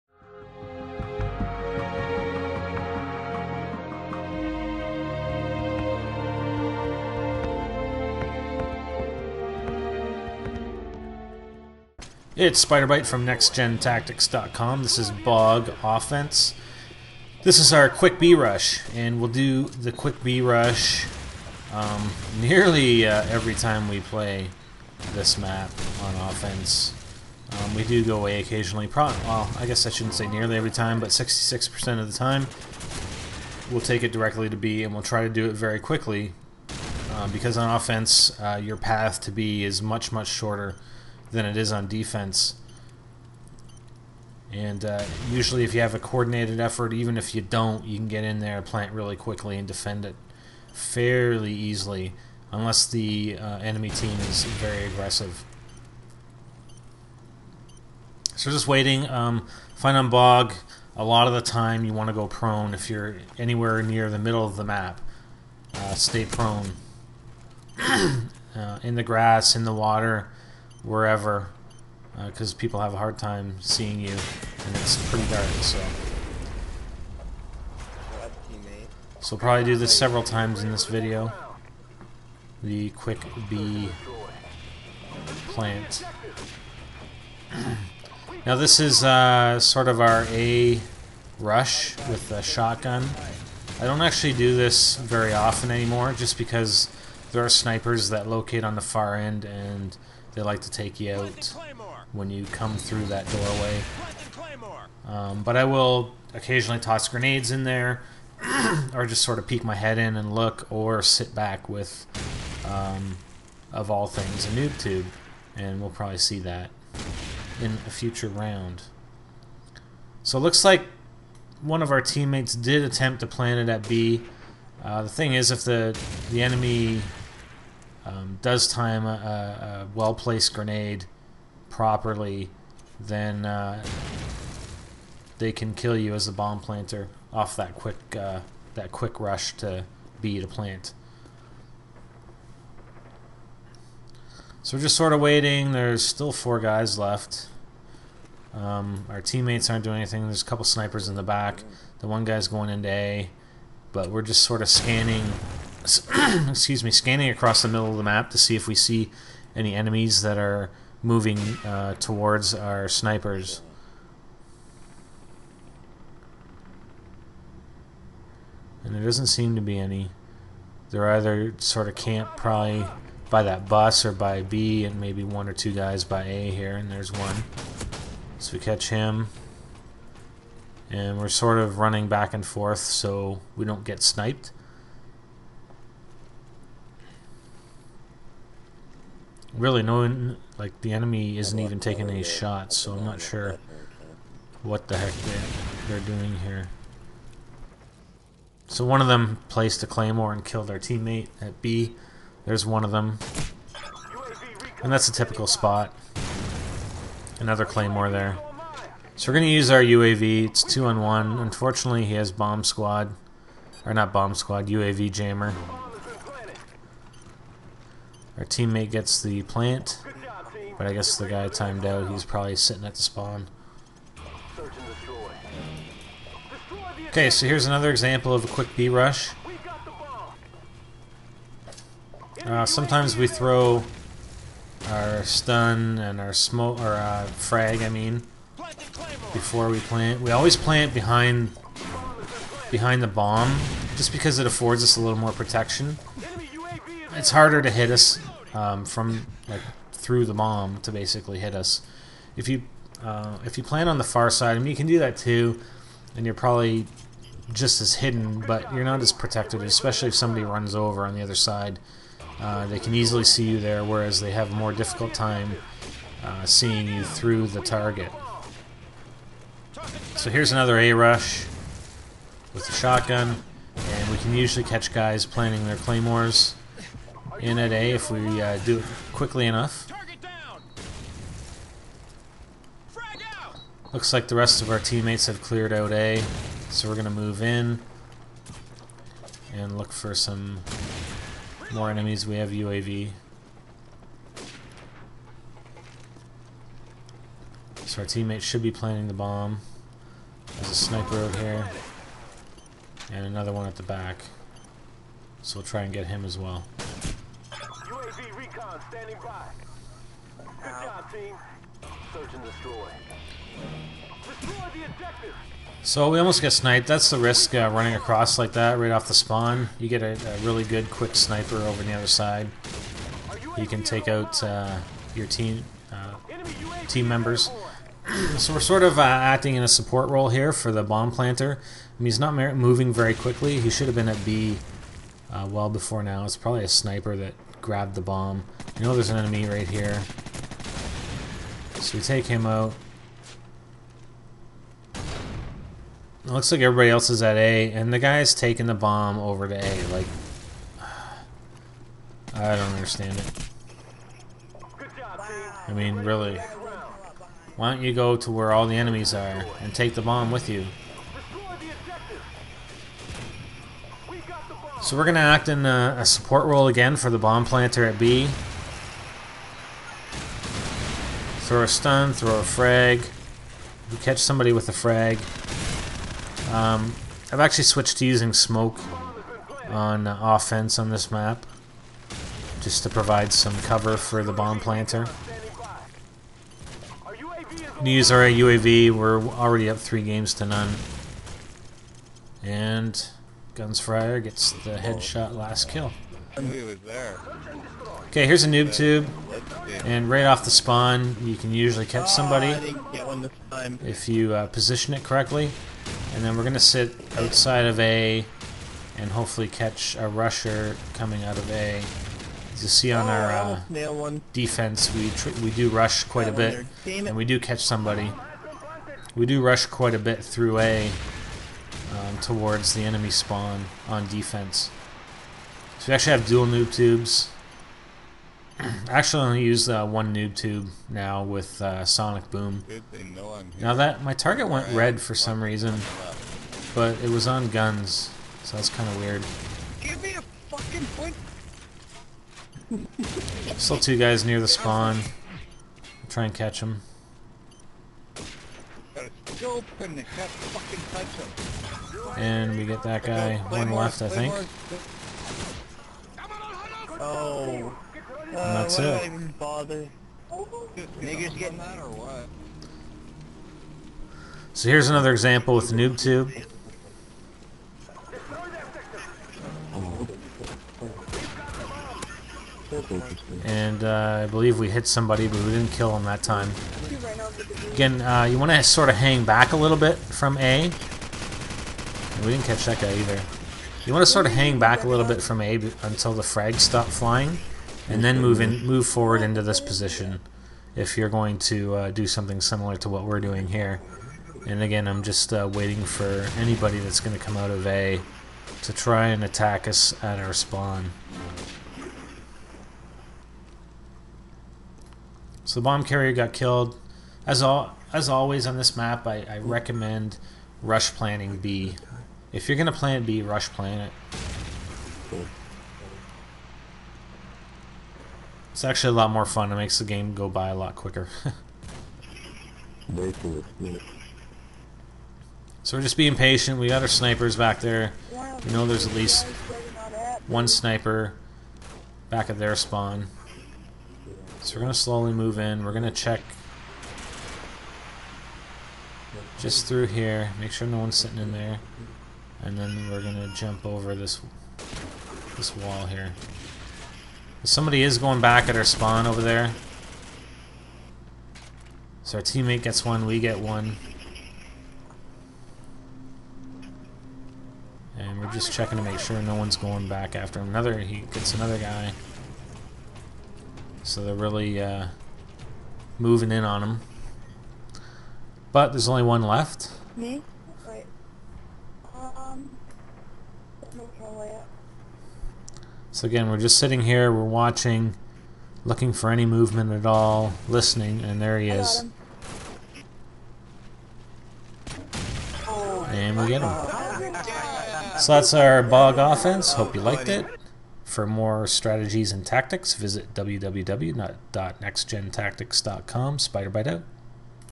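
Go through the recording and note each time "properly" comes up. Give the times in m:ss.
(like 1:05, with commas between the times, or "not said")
2:11.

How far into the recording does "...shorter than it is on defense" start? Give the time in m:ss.
0:40.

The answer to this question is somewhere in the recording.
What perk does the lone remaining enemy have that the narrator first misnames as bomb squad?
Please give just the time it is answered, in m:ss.
3:34.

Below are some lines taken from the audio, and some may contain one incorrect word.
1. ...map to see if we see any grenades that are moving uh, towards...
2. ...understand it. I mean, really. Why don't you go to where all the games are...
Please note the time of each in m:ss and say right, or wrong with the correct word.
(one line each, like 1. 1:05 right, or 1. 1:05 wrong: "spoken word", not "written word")
1. 2:38 wrong: "enemies", not "grenades"
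2. 5:52 wrong: "enemies", not "games".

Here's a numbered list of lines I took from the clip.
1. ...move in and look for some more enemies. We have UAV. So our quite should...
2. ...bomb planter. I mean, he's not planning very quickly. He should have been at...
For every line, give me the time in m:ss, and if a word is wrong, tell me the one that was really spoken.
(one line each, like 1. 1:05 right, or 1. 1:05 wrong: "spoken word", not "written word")
1. 4:47 wrong: "teammate", not "quite"
2. 5:30 wrong: "moving", not "planning".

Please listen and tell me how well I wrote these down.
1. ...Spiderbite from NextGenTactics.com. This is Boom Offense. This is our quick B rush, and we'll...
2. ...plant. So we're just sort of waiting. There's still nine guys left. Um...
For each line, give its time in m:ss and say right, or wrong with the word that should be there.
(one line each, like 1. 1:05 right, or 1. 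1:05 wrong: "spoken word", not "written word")
1. 0:12 wrong: "Bog", not "Boom"
2. 2:20 wrong: "four", not "nine".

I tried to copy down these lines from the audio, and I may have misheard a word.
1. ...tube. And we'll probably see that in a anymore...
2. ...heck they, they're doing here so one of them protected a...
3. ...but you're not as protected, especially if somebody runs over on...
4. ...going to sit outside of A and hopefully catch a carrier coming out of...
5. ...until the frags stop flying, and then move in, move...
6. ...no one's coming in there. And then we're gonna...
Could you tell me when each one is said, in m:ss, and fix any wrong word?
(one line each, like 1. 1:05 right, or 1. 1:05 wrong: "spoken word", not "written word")
1. 1:54 wrong: "future", not "anymore"
2. 3:14 wrong: "placed", not "protected"
3. 4:18 right
4. 6:46 wrong: "rusher", not "carrier"
5. 8:05 right
6. 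9:00 wrong: "sitting", not "coming".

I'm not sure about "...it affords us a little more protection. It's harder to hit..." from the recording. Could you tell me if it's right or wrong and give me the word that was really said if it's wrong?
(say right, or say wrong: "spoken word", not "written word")
right.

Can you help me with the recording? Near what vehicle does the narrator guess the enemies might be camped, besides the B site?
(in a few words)
Bus.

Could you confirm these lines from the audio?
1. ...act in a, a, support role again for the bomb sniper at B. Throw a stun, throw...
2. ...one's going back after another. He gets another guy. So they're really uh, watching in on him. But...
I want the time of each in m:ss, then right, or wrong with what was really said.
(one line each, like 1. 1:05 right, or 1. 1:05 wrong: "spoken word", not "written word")
1. 6:05 wrong: "planter", not "sniper"
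2. 9:19 wrong: "moving", not "watching".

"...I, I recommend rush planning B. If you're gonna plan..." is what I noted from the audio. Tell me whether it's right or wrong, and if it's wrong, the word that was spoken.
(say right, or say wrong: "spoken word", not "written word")
right.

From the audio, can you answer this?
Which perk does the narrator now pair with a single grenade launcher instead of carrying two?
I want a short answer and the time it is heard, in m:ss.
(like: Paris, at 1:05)
Sonic Boom, at 7:11.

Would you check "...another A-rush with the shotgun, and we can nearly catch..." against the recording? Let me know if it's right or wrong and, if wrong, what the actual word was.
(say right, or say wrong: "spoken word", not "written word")
wrong: "usually", not "nearly".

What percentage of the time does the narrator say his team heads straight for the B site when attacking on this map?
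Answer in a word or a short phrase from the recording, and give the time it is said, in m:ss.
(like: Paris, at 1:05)
66%, at 0:31.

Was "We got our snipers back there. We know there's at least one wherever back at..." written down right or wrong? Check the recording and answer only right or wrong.
wrong.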